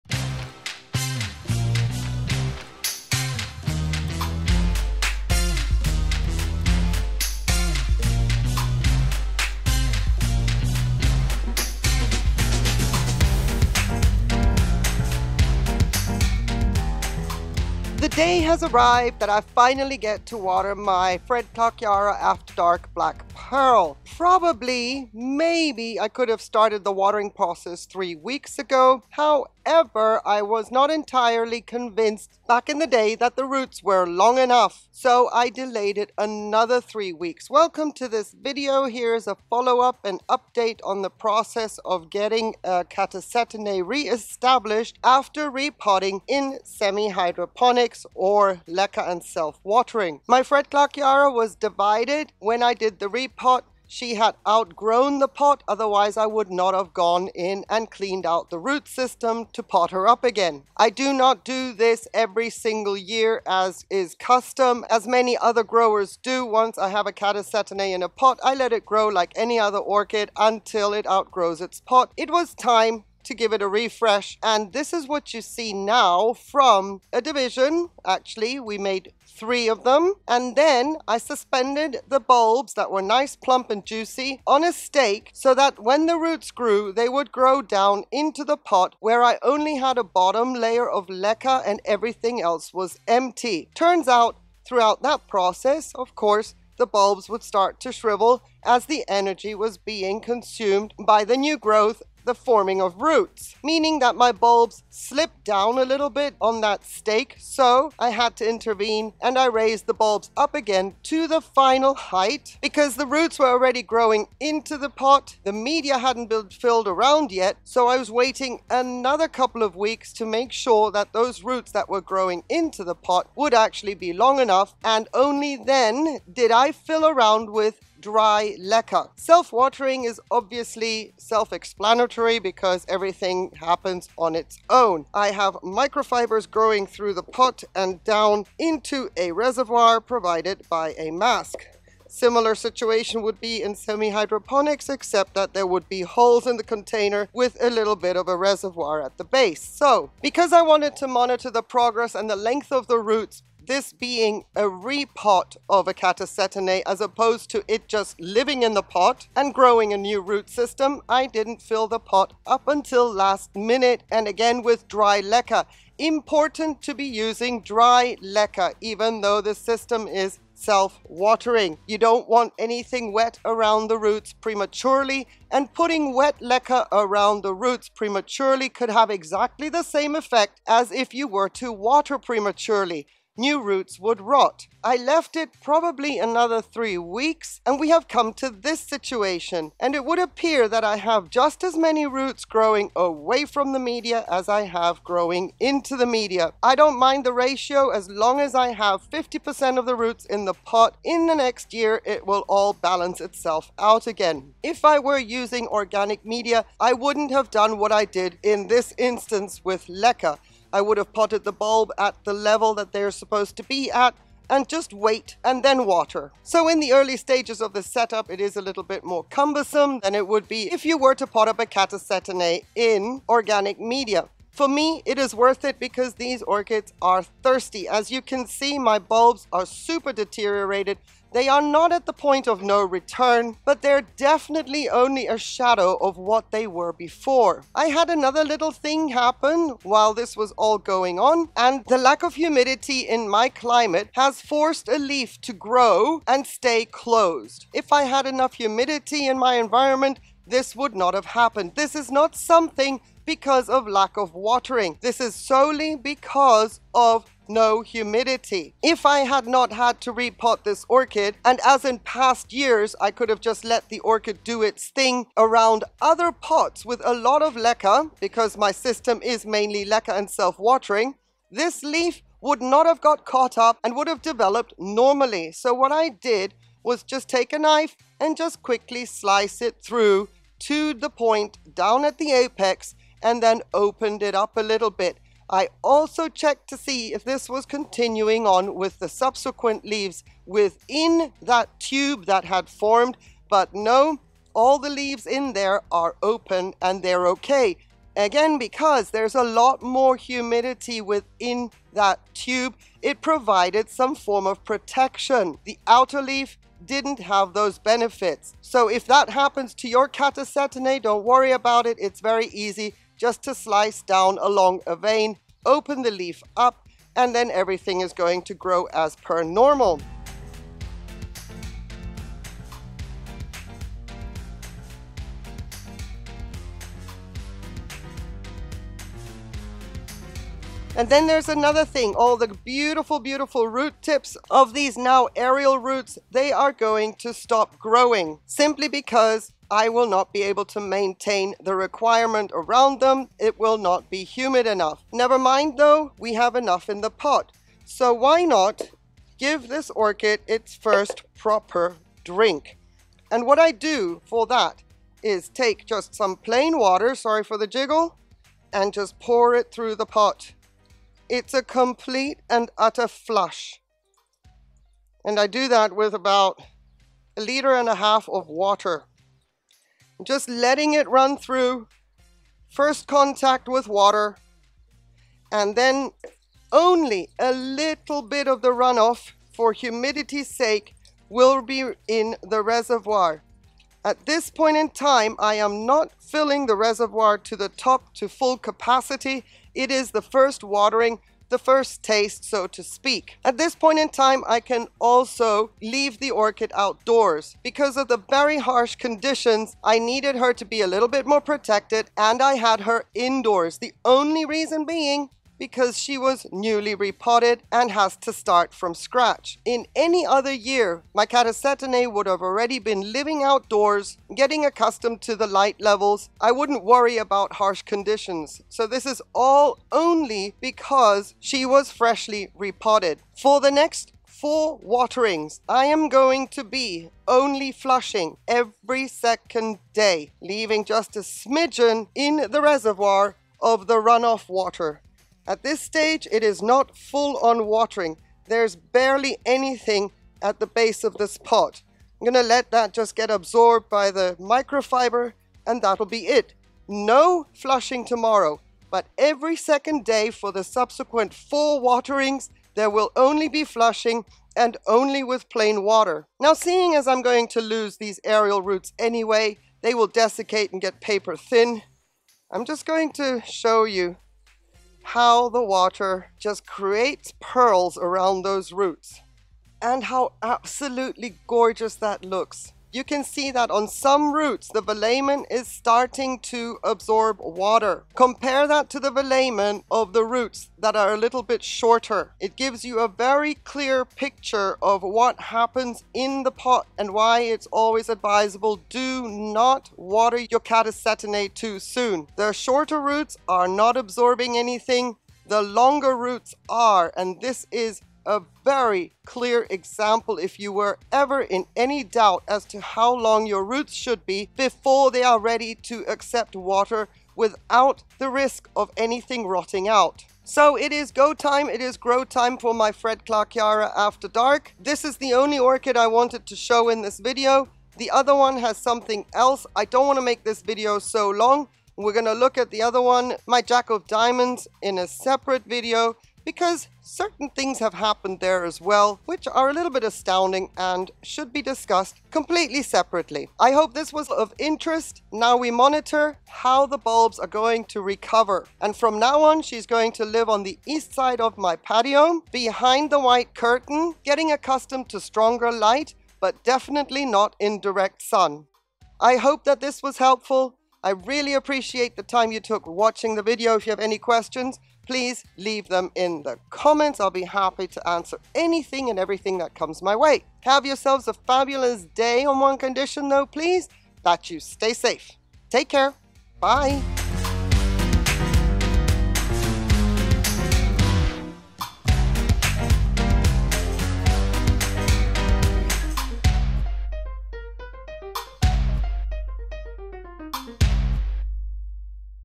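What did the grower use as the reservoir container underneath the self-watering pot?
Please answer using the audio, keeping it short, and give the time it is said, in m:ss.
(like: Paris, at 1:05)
a mask, at 2:20.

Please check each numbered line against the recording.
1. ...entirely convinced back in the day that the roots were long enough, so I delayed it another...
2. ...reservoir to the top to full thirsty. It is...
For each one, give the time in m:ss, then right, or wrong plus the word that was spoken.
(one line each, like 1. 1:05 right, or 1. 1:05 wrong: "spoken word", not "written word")
1. 0:30 right
2. 6:26 wrong: "capacity", not "thirsty".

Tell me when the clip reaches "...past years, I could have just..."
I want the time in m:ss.
4:21.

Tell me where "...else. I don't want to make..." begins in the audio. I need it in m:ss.
8:39.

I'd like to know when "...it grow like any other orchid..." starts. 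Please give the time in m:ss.
1:08.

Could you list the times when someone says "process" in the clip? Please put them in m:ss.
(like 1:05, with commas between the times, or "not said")
0:27, 0:41, 1:35.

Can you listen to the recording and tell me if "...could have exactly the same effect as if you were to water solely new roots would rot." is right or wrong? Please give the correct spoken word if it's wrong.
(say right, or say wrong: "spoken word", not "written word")
wrong: "prematurely", not "solely".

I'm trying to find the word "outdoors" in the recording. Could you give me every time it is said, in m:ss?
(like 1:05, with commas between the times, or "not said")
6:36, 6:53.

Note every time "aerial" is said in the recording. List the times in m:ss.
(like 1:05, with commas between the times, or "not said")
5:35, 7:38.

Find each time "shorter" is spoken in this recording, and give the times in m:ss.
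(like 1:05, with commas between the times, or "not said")
8:01, 8:12.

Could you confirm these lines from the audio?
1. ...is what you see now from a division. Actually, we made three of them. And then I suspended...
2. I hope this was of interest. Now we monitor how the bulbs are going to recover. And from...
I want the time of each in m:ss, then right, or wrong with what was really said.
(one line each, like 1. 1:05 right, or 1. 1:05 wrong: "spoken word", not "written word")
1. 1:14 right
2. 8:53 right.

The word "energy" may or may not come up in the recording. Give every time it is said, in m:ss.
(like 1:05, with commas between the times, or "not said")
1:39.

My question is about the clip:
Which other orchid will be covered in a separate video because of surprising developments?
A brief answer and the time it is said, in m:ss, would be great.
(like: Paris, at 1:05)
Jack of Diamonds, at 8:43.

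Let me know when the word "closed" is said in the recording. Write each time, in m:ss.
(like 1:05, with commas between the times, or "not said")
4:06.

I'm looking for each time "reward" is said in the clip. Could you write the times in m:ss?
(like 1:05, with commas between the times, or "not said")
not said.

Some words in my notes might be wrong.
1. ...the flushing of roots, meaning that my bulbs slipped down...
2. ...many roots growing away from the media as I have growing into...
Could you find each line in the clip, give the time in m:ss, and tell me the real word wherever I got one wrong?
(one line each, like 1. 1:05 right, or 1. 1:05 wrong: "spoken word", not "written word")
1. 1:42 wrong: "forming", not "flushing"
2. 3:11 right.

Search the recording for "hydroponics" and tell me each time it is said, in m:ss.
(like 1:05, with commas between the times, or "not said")
0:46, 2:23.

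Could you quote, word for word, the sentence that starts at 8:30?
So it is go time, it is grow time for my Fredclarkeara After Dark.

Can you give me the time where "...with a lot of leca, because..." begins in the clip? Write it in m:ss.
4:26.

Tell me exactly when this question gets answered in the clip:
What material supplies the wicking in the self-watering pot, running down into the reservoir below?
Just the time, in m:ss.
2:15.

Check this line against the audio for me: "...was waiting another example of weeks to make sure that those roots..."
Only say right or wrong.
wrong.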